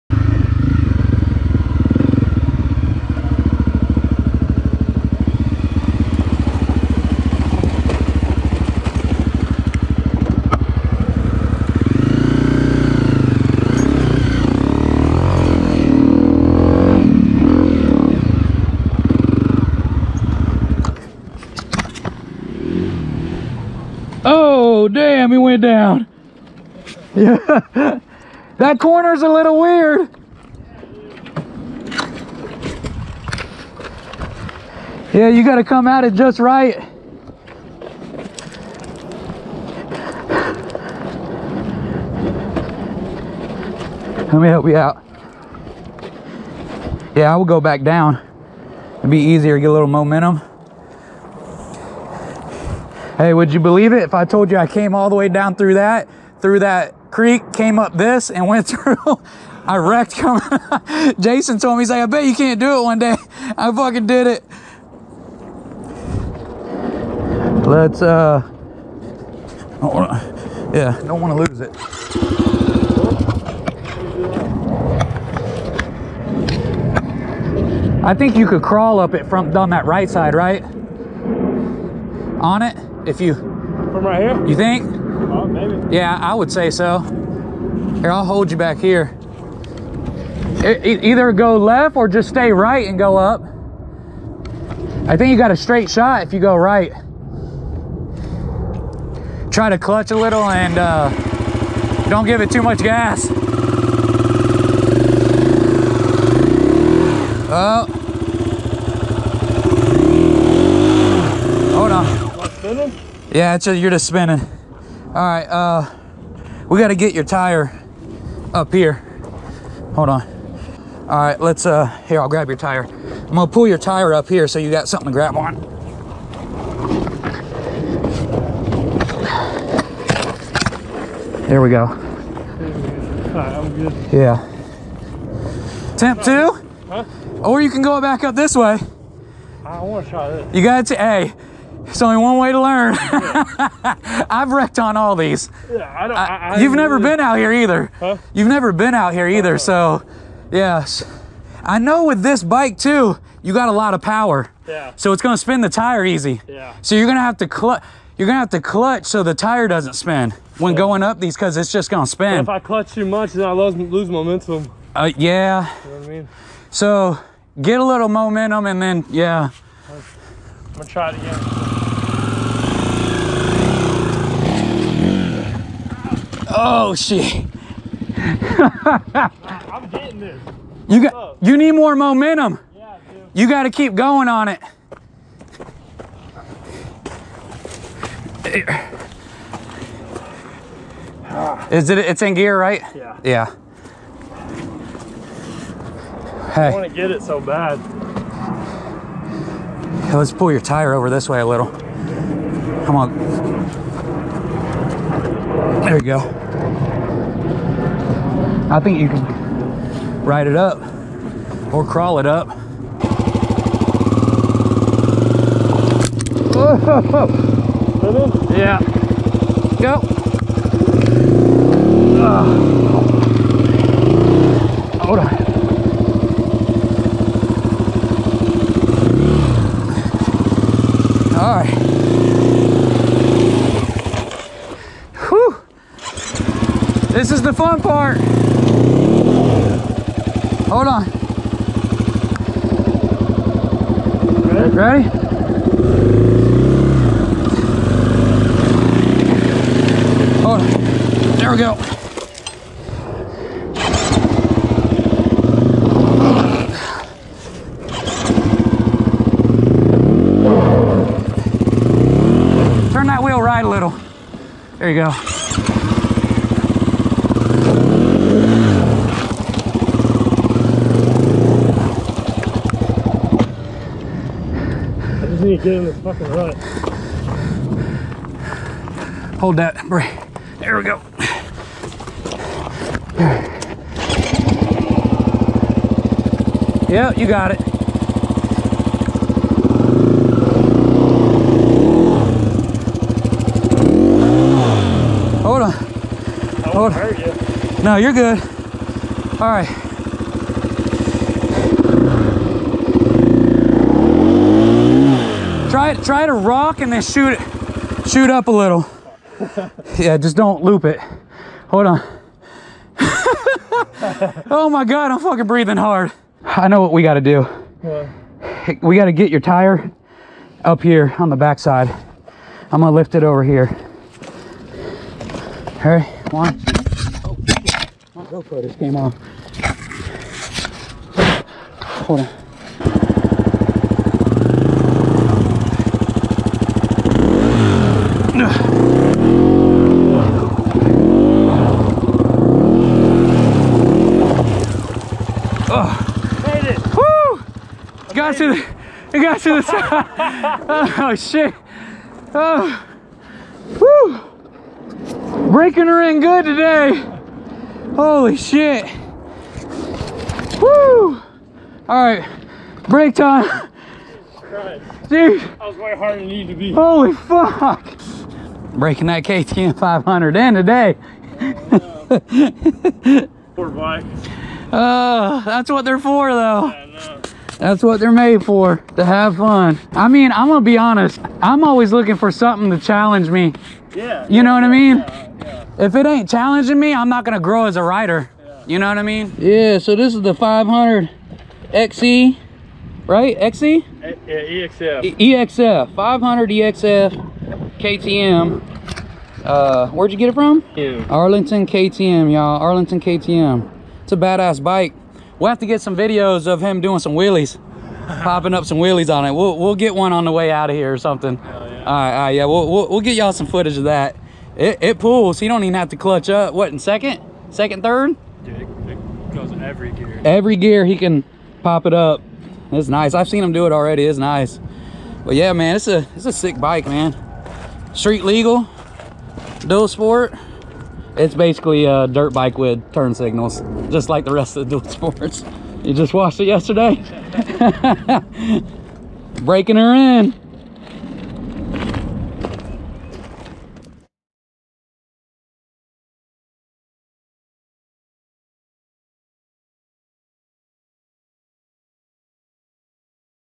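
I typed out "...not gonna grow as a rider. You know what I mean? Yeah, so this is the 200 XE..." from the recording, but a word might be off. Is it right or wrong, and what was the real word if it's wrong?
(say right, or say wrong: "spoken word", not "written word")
wrong: "500", not "200".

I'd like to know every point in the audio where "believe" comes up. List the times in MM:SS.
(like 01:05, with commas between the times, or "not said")
00:53.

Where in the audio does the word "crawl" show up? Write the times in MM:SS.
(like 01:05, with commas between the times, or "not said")
01:18, 03:31.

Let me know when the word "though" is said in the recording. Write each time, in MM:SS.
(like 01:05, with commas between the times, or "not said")
06:16.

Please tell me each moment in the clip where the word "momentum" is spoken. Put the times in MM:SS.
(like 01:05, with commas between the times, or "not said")
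00:49, 02:44, 02:48, 03:01.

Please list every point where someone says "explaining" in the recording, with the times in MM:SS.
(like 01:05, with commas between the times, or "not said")
not said.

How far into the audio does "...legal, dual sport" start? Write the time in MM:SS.
07:08.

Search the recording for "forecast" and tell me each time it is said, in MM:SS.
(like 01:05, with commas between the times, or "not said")
not said.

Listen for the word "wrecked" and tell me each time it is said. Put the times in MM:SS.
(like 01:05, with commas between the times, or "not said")
00:59, 02:24.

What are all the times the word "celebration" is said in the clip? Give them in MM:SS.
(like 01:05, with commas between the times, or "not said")
not said.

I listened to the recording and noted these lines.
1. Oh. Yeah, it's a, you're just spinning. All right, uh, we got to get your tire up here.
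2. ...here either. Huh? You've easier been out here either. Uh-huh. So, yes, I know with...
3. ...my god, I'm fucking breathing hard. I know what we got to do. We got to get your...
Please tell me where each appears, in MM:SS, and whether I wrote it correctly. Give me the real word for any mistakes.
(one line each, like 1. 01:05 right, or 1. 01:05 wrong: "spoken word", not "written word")
1. 01:47 right
2. 02:27 wrong: "never", not "easier"
3. 05:14 right.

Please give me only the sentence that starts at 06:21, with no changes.
I'm always looking for something to challenge me.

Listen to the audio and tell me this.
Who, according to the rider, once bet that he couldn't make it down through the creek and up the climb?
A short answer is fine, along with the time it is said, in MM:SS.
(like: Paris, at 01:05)
Jason, at 01:01.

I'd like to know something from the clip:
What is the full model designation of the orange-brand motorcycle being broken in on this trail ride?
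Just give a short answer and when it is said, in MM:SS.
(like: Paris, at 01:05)
500 EXF, at 06:35.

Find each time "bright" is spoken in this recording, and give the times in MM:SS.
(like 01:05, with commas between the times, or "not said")
not said.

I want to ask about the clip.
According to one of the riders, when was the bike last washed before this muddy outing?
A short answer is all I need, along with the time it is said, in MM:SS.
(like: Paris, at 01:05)
Yesterday, at 07:16.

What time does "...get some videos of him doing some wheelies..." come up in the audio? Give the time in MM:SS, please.
06:45.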